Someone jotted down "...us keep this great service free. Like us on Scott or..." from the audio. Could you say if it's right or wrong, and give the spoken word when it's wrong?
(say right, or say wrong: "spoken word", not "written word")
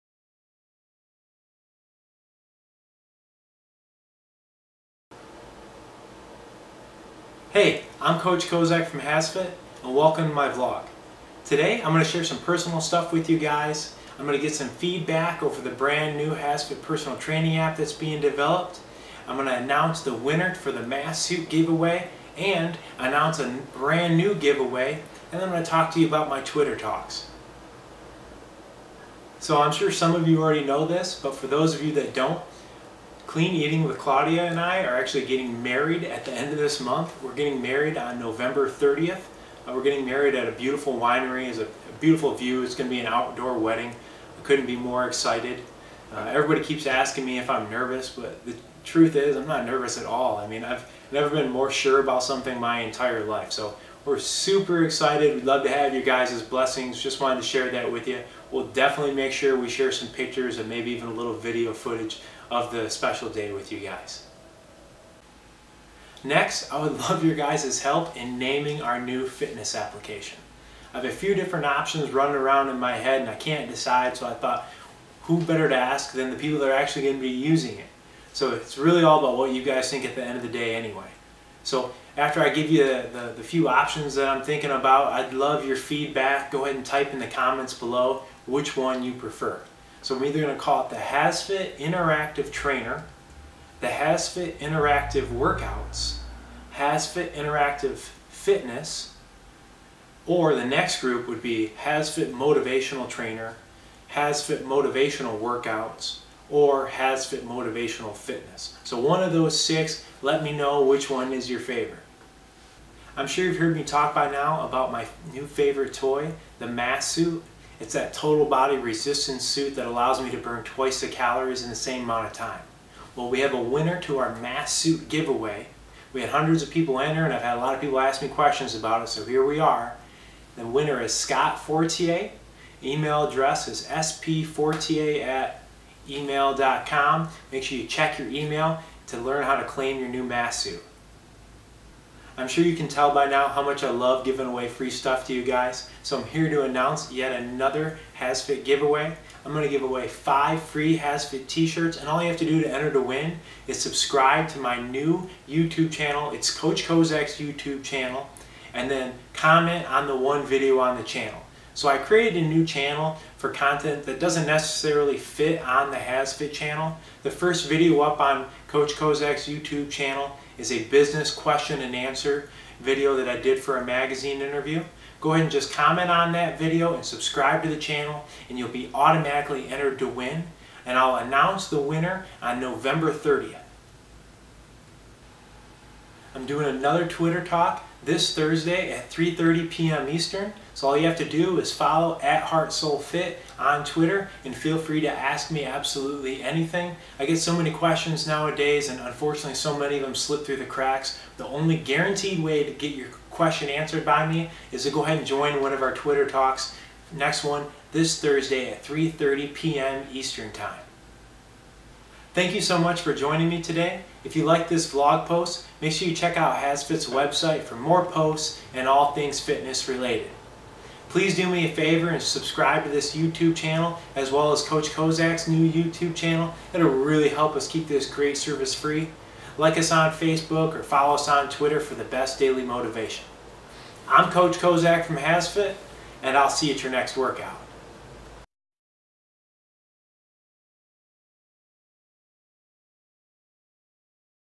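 wrong: "Facebook", not "Scott".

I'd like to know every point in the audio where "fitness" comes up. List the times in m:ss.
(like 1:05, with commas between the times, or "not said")
1:09, 1:38, 1:48, 3:39.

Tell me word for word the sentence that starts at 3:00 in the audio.
And I'll announce the winner on November 30th.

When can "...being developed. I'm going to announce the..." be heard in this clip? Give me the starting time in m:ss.
0:17.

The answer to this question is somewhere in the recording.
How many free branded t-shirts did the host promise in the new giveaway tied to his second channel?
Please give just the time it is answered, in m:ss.
2:30.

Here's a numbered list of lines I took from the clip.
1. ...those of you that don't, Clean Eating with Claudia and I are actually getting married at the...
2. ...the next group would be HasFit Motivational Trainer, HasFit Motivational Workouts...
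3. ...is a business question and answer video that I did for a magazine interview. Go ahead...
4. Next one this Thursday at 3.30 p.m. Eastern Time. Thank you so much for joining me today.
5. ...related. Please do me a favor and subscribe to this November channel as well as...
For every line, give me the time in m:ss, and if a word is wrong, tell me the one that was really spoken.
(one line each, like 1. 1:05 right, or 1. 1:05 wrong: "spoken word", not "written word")
1. 0:31 right
2. 1:40 right
3. 2:50 right
4. 3:27 right
5. 3:39 wrong: "YouTube", not "November".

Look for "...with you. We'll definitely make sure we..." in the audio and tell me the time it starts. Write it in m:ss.
0:57.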